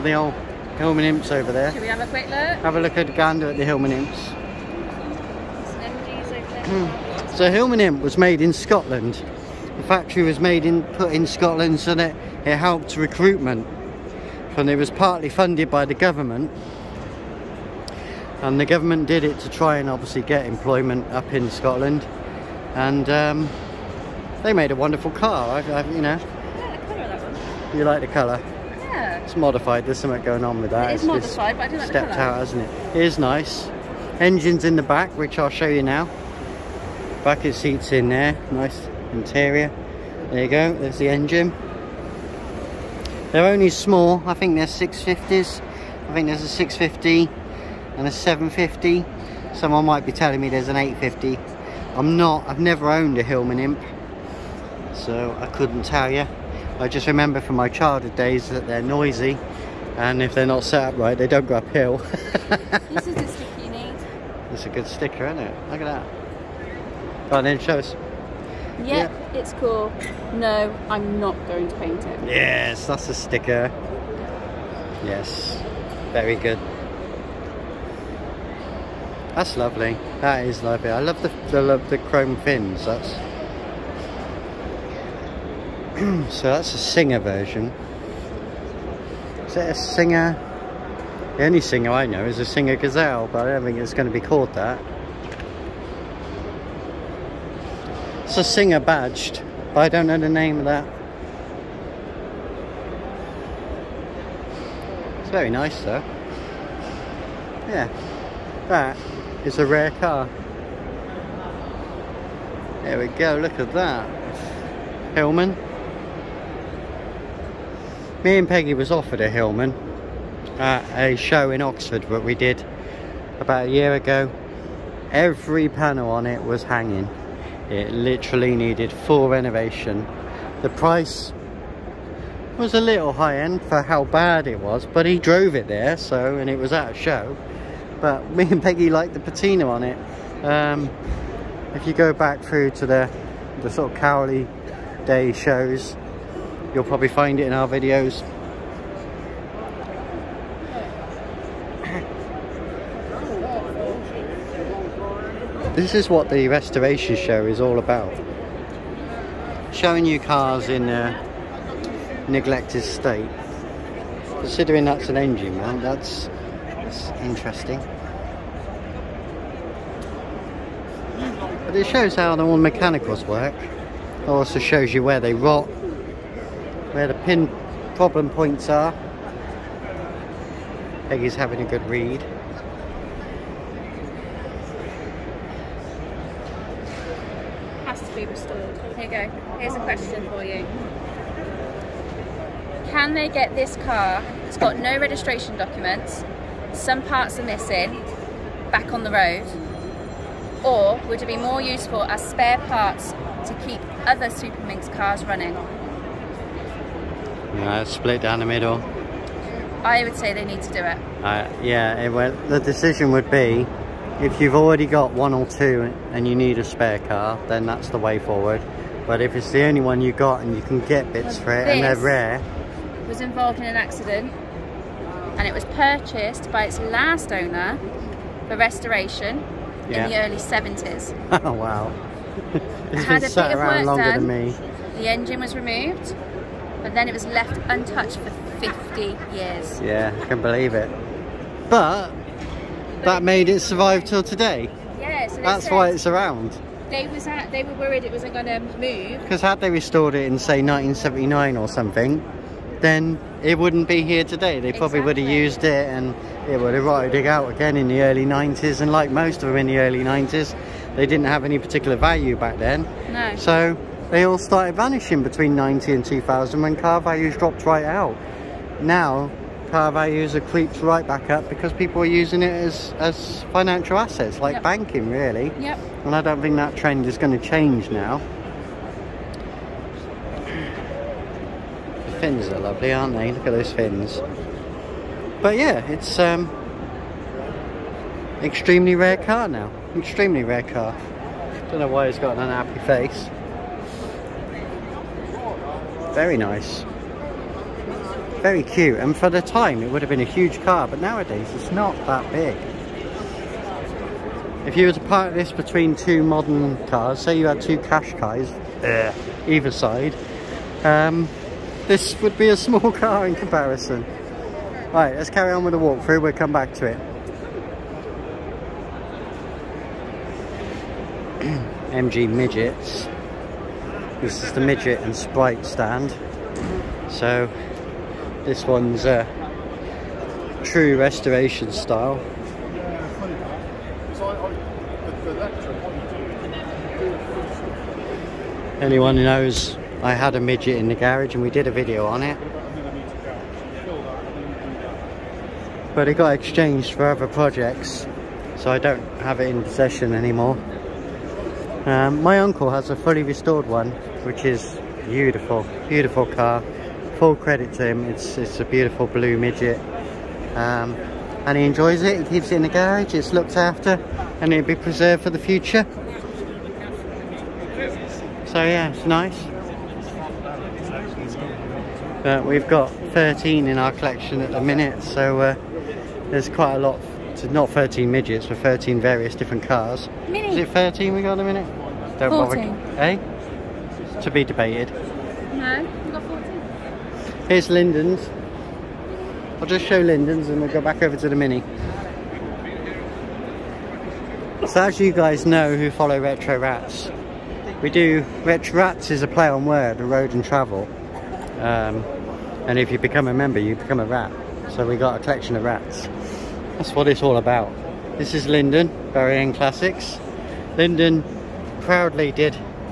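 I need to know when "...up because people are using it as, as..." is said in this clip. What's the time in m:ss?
4:31.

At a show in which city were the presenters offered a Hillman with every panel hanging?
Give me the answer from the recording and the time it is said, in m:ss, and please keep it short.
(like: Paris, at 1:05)
Oxford, at 2:01.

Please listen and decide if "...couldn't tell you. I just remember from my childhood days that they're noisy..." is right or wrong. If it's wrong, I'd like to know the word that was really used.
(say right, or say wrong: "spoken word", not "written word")
right.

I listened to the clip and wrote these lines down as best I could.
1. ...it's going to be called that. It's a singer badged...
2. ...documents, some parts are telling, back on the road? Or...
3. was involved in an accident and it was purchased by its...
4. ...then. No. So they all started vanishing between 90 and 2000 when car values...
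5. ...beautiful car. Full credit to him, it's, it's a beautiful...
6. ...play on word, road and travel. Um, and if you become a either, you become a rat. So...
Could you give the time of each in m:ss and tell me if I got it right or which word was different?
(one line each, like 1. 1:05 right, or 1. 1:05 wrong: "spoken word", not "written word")
1. 1:33 right
2. 3:15 wrong: "missing", not "telling"
3. 3:43 right
4. 4:22 right
5. 5:55 right
6. 6:39 wrong: "member", not "either".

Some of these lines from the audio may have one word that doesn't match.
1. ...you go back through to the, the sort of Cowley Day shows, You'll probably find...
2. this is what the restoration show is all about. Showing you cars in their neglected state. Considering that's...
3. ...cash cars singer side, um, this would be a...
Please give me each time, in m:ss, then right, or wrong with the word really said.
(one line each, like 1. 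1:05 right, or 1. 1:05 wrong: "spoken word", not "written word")
1. 2:21 right
2. 2:35 right
3. 5:07 wrong: "either", not "singer".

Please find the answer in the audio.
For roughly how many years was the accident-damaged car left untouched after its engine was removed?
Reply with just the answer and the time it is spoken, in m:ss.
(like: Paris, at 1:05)
50 years, at 3:58.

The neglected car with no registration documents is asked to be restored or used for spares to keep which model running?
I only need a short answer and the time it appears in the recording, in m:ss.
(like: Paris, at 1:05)
Superminx, at 3:24.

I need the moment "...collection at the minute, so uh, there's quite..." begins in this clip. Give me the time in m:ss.
6:13.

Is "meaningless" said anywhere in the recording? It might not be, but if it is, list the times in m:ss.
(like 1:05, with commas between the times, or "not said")
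not said.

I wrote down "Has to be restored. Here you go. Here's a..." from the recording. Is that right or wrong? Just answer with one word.
right.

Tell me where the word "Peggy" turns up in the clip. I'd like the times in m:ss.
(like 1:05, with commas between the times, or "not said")
1:58, 2:18, 3:01.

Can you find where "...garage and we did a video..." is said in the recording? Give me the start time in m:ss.
5:40.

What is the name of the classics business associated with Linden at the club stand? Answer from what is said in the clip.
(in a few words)
Barry End Classics.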